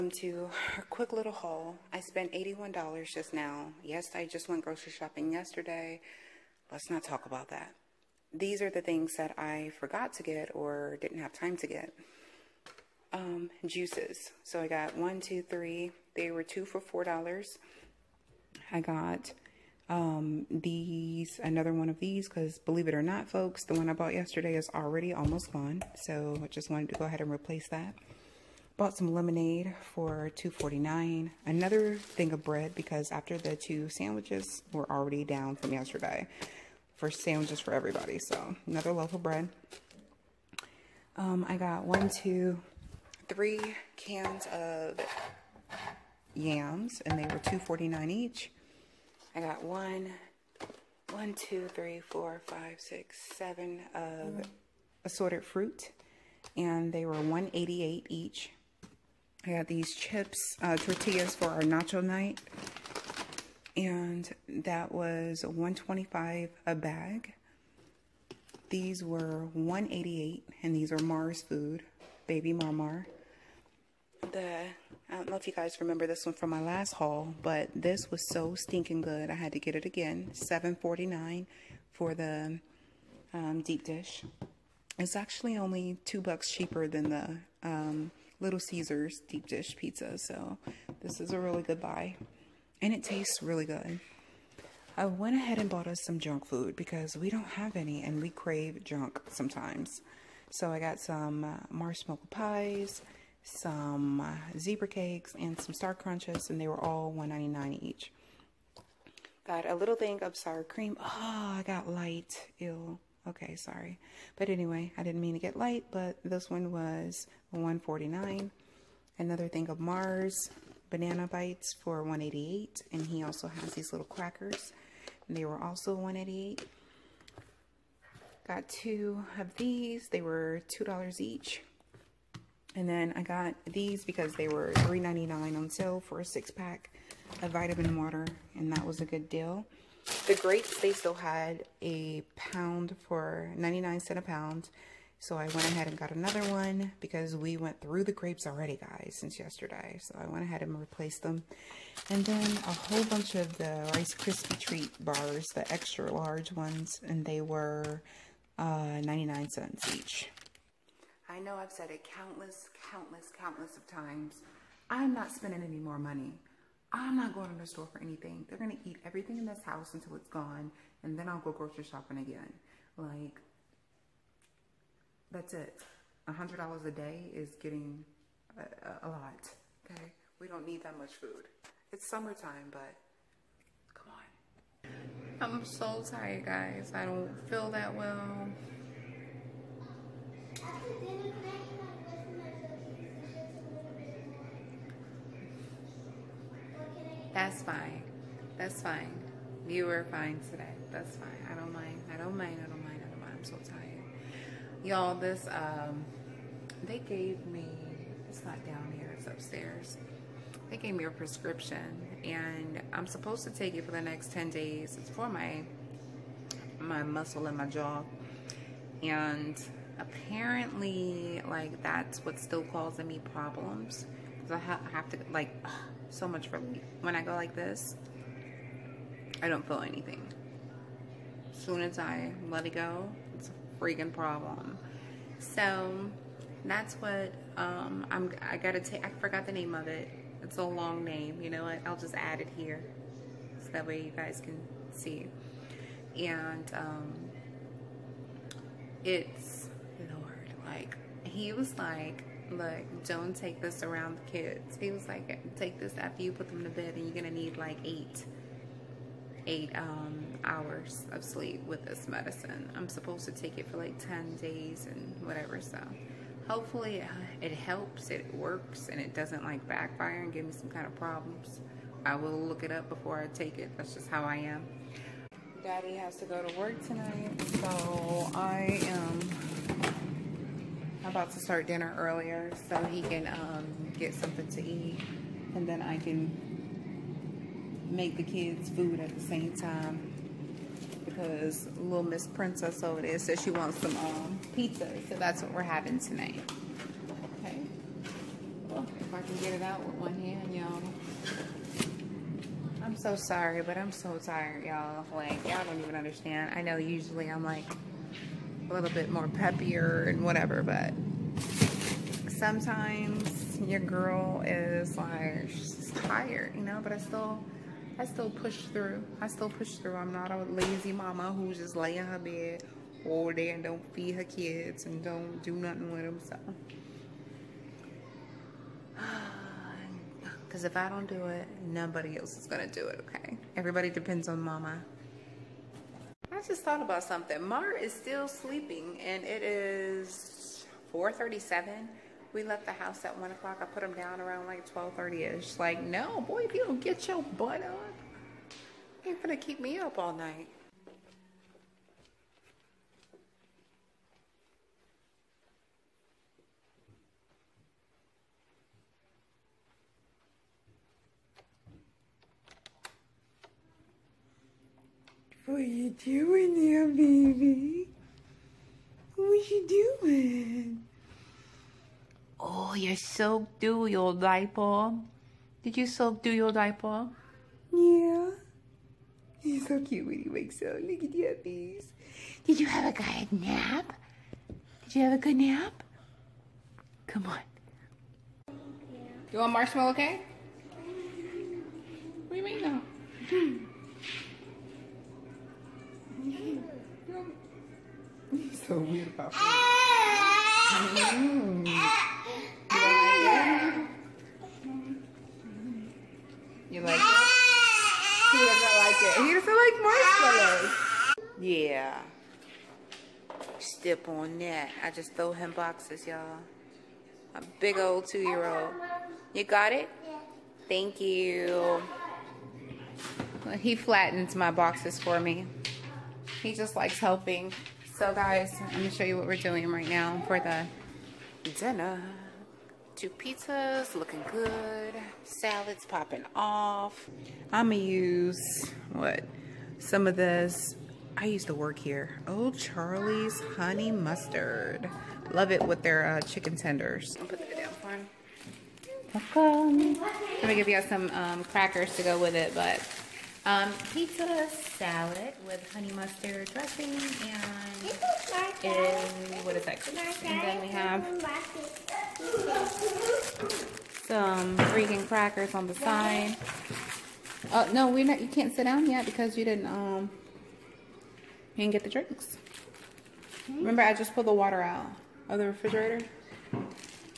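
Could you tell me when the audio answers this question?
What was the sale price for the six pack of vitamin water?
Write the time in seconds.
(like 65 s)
134 s.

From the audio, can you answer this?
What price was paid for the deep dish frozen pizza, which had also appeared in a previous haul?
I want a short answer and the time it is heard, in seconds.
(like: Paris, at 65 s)
$7.49, at 80 s.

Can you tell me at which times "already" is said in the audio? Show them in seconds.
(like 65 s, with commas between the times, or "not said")
24 s, 34 s, 148 s.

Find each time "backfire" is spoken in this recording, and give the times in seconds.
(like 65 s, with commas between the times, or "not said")
269 s.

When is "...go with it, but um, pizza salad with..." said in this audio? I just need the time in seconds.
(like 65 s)
452 s.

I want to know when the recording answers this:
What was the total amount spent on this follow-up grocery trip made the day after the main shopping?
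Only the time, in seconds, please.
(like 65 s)
2 s.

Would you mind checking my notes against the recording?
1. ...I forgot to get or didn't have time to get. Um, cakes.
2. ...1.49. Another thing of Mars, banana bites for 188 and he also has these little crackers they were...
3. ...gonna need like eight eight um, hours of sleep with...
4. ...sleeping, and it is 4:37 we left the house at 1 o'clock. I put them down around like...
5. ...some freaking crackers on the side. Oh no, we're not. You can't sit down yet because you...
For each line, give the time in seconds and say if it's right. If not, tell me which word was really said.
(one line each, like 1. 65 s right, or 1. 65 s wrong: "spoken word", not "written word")
1. 9 s wrong: "juices", not "cakes"
2. 117 s right
3. 257 s right
4. 338 s right
5. 464 s right.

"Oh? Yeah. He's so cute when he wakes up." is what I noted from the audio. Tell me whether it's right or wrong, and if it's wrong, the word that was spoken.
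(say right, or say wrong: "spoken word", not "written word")
right.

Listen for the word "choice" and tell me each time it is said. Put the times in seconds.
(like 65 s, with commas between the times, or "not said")
not said.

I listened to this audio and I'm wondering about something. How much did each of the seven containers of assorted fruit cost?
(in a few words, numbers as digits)
$1.88.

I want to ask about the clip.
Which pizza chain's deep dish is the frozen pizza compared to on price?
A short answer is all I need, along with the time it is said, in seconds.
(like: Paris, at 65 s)
Little Caesars, at 88 s.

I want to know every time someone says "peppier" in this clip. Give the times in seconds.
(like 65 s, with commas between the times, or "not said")
309 s.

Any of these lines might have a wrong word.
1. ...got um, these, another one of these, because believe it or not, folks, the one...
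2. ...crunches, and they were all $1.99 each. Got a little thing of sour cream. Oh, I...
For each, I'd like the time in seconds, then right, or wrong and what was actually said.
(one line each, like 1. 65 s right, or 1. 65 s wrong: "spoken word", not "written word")
1. 18 s right
2. 105 s right.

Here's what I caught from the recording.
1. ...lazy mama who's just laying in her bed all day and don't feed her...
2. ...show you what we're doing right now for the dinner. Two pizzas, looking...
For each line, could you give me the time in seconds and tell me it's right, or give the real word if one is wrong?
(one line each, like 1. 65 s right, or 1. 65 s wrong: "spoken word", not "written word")
1. 320 s right
2. 428 s right.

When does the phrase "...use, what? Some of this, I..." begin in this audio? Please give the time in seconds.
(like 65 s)
437 s.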